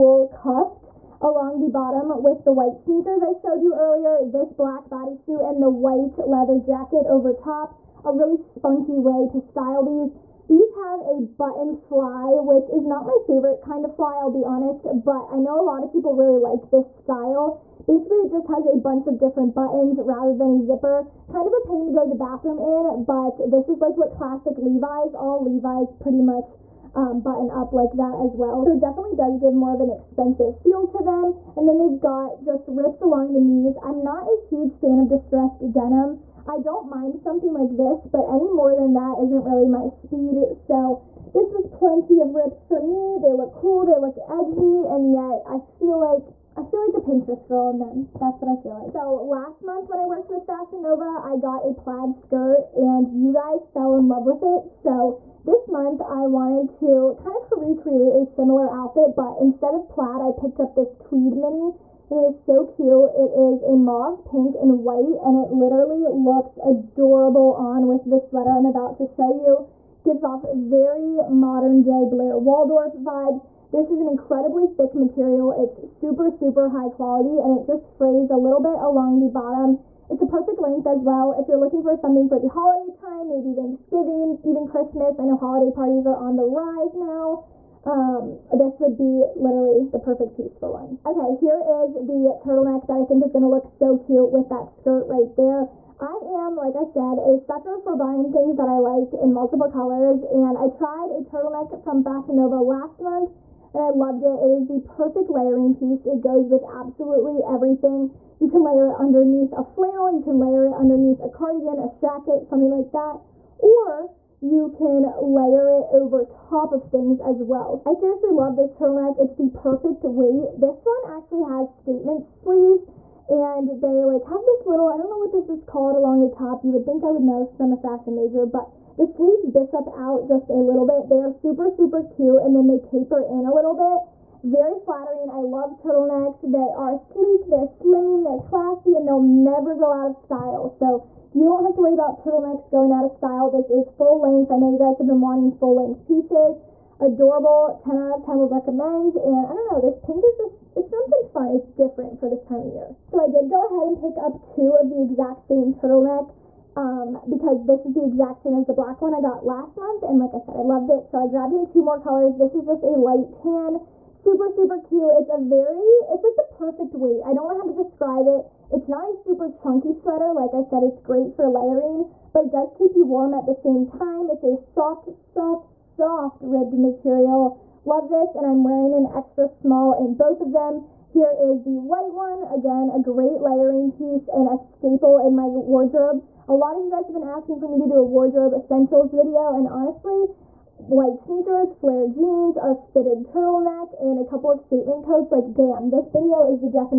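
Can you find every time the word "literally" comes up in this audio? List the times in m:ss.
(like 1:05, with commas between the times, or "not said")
1:05, 1:29.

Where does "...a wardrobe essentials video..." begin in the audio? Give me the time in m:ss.
3:08.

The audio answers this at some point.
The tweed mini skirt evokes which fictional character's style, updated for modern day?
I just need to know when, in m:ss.
1:12.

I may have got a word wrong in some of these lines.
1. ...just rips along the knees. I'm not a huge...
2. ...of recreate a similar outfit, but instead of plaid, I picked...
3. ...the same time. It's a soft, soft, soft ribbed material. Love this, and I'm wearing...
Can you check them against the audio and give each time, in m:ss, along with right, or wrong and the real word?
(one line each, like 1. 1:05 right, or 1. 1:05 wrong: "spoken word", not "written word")
1. 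0:32 right
2. 0:57 right
3. 2:53 right.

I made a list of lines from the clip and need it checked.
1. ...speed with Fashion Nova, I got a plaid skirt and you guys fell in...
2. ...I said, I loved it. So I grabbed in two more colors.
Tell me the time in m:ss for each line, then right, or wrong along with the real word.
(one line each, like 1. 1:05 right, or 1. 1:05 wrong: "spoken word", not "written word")
1. 0:50 wrong: "worked", not "speed"
2. 2:40 right.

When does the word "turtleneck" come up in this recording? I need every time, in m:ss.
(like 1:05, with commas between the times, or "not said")
1:32, 1:41, 1:58, 2:15, 2:22, 2:35, 3:13.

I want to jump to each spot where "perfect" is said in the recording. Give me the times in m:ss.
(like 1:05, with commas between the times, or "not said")
1:20, 1:29, 1:44, 1:59, 2:46.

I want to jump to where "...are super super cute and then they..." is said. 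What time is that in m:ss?
2:11.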